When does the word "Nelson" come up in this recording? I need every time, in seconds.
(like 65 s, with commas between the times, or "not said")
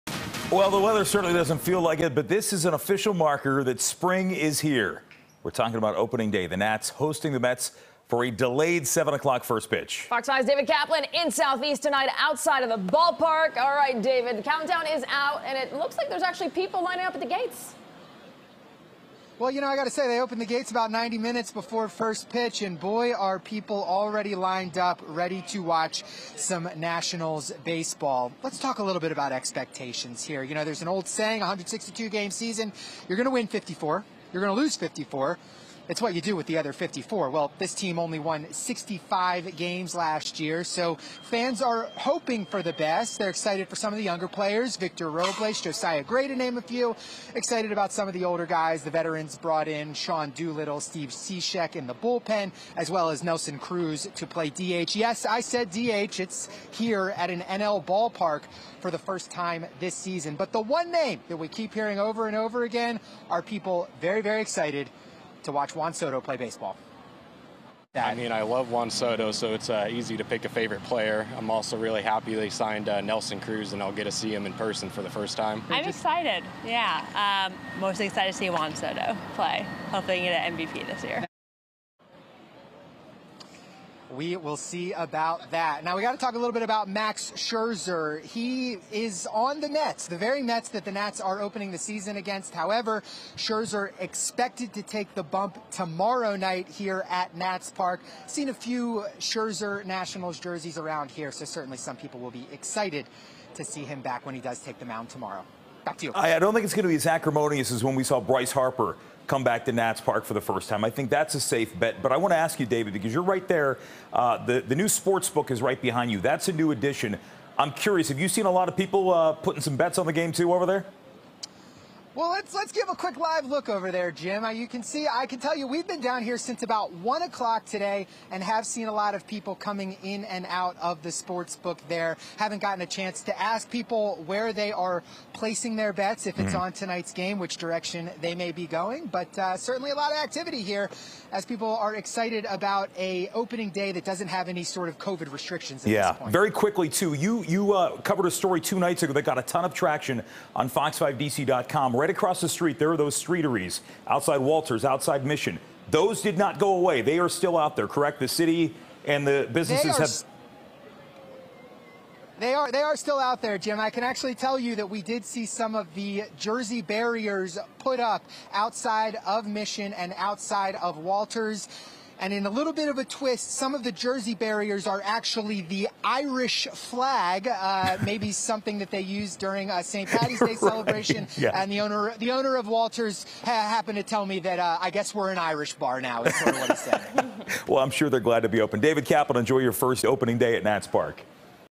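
53 s, 73 s.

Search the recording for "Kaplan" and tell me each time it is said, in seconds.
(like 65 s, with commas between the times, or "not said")
10 s, 189 s.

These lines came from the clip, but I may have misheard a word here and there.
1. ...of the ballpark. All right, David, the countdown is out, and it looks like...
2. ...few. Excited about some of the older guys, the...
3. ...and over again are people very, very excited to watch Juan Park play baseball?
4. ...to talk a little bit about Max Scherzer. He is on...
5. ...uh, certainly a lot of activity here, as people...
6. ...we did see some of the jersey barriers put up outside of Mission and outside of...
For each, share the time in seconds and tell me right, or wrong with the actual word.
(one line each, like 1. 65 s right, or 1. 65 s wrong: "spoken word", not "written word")
1. 12 s right
2. 46 s right
3. 62 s wrong: "Soto", not "Park"
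4. 86 s right
5. 139 s right
6. 164 s right.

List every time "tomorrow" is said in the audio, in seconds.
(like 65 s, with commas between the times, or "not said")
95 s, 105 s.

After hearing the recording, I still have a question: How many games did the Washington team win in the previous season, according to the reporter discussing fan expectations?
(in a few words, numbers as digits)
65.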